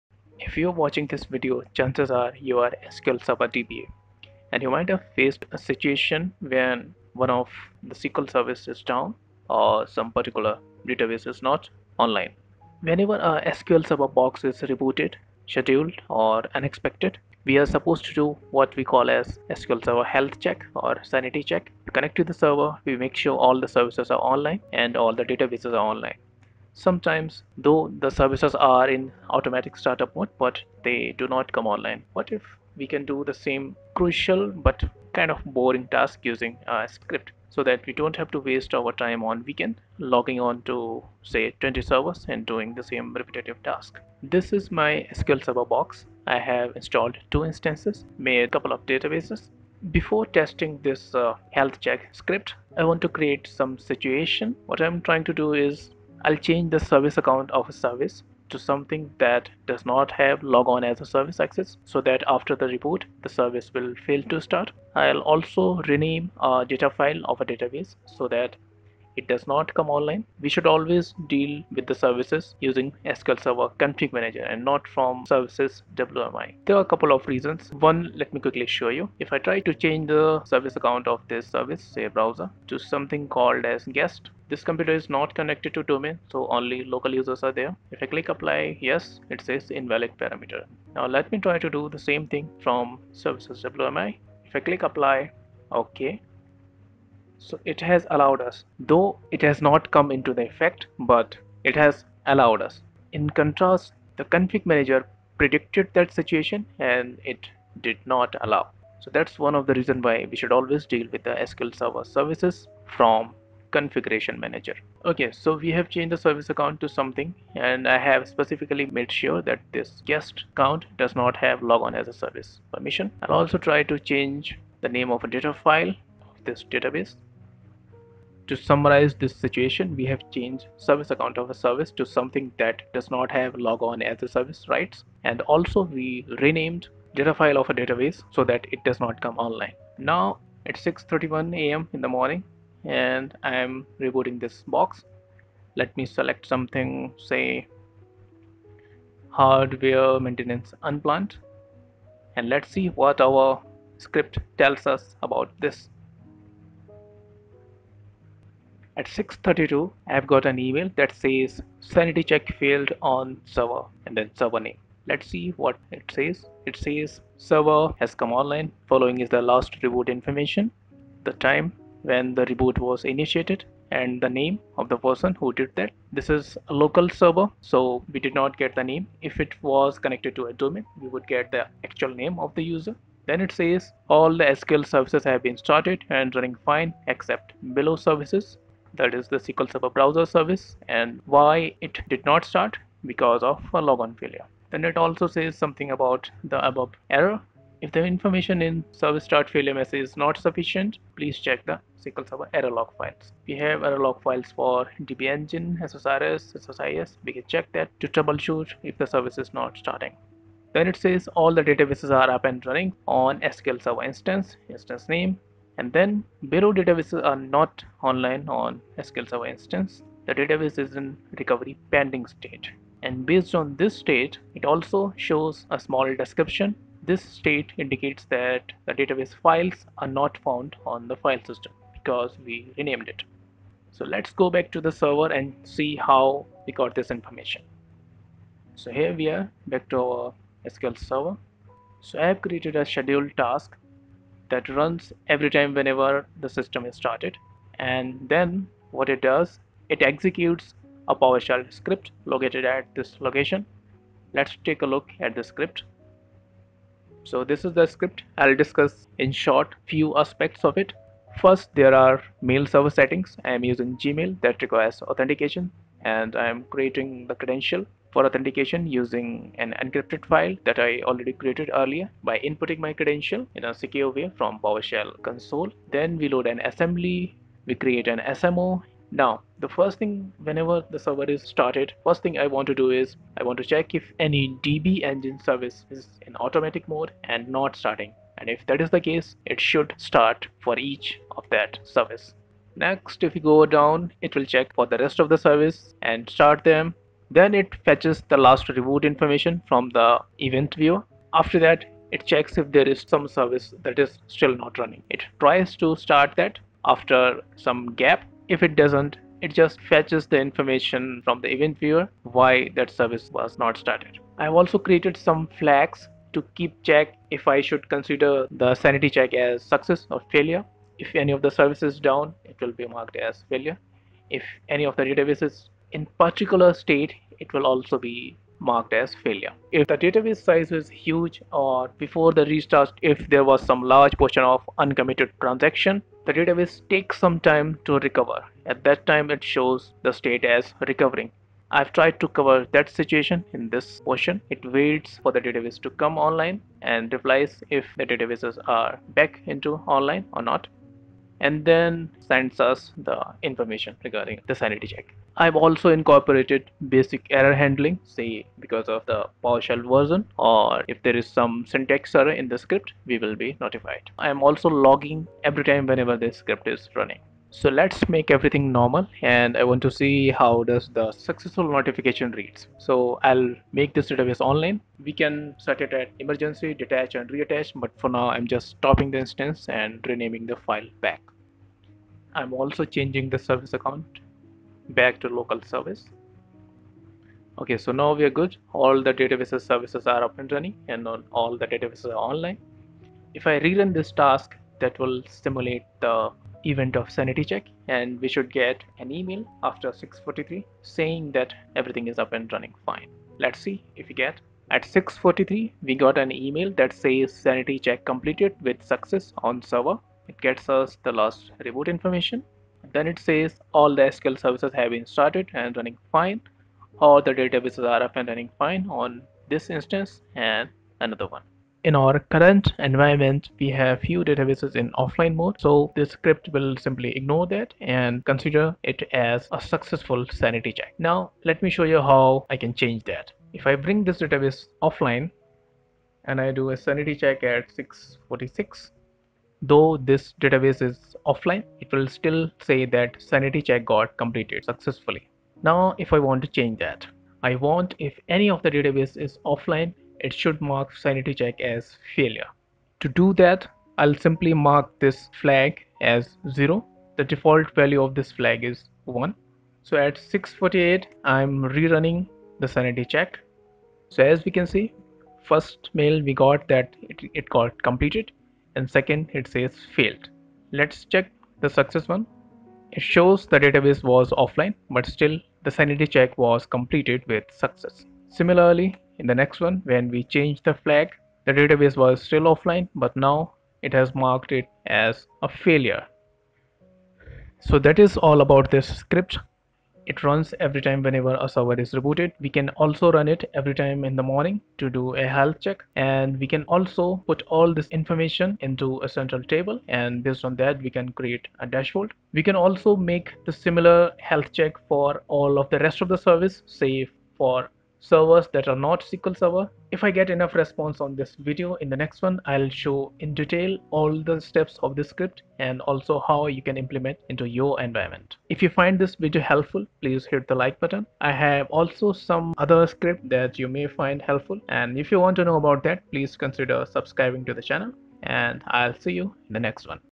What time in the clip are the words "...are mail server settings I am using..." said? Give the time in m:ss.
4:21.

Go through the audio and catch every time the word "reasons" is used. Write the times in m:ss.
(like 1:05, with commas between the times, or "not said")
1:17, 1:49.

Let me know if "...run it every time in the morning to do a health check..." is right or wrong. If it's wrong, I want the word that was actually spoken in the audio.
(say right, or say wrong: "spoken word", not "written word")
right.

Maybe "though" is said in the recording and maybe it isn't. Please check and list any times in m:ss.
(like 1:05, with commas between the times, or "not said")
0:27, 1:38, 7:19.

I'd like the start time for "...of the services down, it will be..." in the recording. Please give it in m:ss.
5:21.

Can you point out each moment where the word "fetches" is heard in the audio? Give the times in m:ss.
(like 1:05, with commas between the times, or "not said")
4:57, 5:09.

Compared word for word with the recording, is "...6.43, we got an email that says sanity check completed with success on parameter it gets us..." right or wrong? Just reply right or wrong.
wrong.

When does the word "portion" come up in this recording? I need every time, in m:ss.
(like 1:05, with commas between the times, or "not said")
5:34, 5:44.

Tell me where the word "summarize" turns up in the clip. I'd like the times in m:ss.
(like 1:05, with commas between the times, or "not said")
2:08.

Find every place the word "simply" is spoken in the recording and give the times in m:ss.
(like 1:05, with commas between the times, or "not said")
7:06, 7:34.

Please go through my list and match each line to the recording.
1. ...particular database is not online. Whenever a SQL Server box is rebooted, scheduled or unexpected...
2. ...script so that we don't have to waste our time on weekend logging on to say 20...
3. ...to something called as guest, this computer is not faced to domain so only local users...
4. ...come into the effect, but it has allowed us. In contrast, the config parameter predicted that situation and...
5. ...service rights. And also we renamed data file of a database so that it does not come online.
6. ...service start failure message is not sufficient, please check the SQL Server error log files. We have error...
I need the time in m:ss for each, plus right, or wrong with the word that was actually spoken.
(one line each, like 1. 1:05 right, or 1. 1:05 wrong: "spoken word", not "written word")
1. 0:10 right
2. 0:36 right
3. 1:22 wrong: "connected", not "faced"
4. 1:39 wrong: "manager", not "parameter"
5. 2:14 right
6. 3:18 right.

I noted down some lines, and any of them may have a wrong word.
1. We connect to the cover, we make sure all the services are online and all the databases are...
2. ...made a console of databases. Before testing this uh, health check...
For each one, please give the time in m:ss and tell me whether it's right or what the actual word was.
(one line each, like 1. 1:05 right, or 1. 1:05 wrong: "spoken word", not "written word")
1. 0:21 wrong: "server", not "cover"
2. 0:48 wrong: "couple", not "console".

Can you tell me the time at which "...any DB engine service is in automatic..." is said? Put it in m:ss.
4:44.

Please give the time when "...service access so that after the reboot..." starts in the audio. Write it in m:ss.
1:01.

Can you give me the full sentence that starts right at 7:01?
In our current environment, we have few databases in offline mode.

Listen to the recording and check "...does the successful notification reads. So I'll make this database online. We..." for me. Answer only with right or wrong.
right.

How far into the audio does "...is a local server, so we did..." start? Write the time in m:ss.
2:56.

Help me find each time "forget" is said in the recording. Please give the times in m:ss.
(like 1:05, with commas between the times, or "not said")
not said.